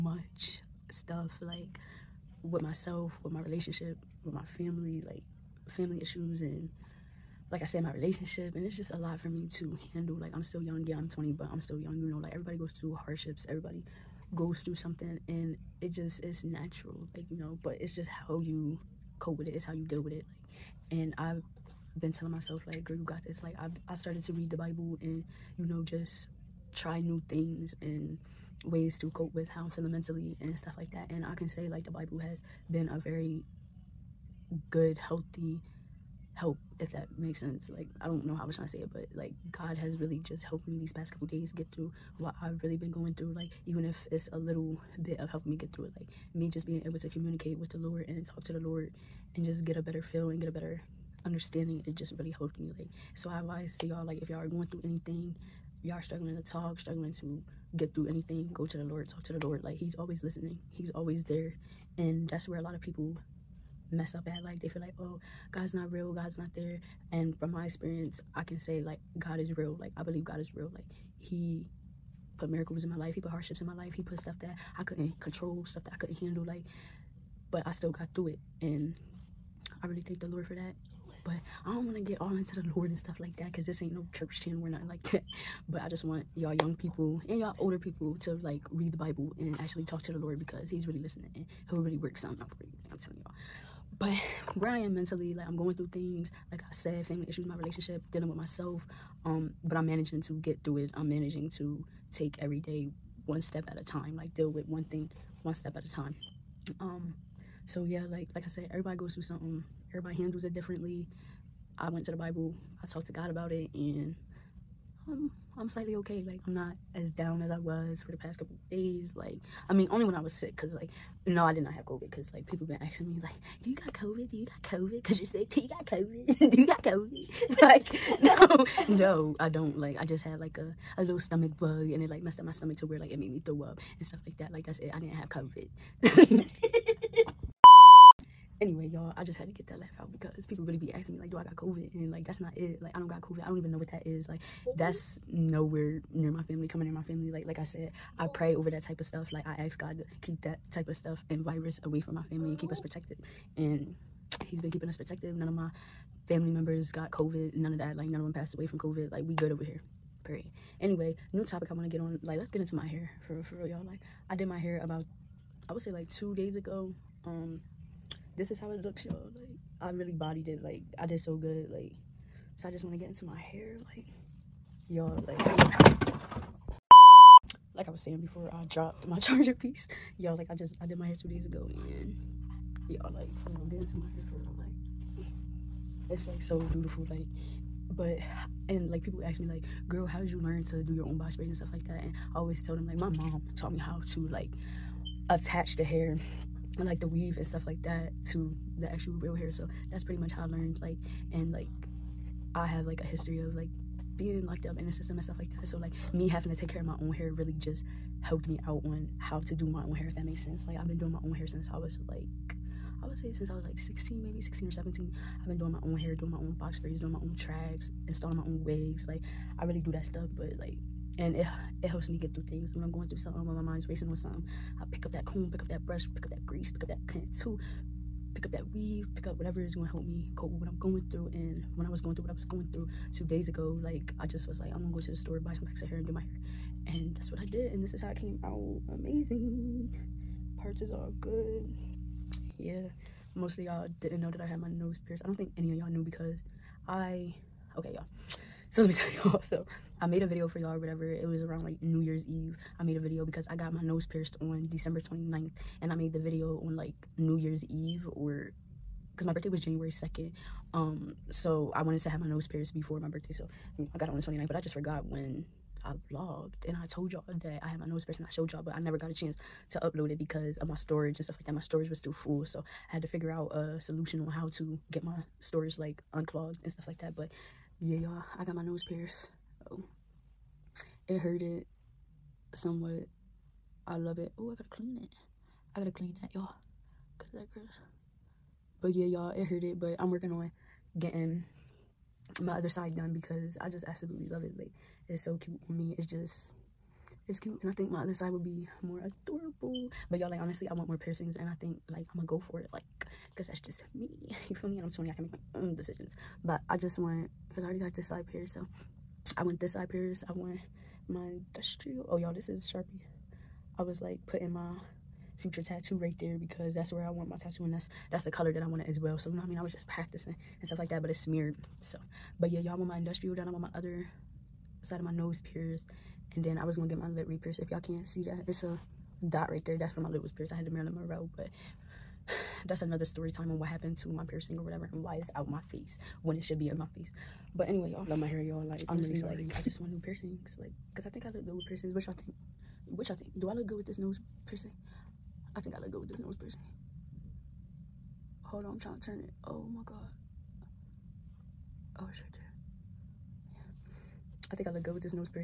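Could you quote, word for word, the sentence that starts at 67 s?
And from my experience, I can say, like, God is real.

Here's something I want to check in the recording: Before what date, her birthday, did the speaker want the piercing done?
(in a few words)
January 2nd.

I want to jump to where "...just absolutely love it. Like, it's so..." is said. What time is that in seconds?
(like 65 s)
293 s.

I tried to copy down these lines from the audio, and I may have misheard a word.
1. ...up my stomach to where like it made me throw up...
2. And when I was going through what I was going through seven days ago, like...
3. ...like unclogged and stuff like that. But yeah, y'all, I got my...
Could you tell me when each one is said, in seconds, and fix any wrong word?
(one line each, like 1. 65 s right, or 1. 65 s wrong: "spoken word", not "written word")
1. 132 s right
2. 231 s wrong: "two", not "seven"
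3. 275 s right.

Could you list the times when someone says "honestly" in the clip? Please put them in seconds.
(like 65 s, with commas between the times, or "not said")
300 s, 338 s.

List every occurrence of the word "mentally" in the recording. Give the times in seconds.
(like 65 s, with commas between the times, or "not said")
29 s, 94 s.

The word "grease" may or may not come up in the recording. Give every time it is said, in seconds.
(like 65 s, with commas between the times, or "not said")
226 s.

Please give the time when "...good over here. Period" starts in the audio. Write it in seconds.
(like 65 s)
159 s.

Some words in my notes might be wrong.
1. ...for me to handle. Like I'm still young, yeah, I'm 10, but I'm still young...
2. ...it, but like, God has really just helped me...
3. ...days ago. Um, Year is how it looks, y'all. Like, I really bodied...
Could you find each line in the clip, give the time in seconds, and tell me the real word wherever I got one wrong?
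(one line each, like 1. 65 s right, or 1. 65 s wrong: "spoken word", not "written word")
1. 9 s wrong: "20", not "10"
2. 38 s right
3. 166 s wrong: "This", not "Year".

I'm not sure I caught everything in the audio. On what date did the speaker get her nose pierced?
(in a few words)
December 29th.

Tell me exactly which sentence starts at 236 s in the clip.
And that's what I did, and this is how I came out amazing parts is all good.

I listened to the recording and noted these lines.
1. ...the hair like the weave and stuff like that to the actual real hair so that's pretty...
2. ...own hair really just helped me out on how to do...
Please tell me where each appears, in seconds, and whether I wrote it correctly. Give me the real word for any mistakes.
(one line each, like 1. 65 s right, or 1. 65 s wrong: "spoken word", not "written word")
1. 195 s right
2. 207 s right.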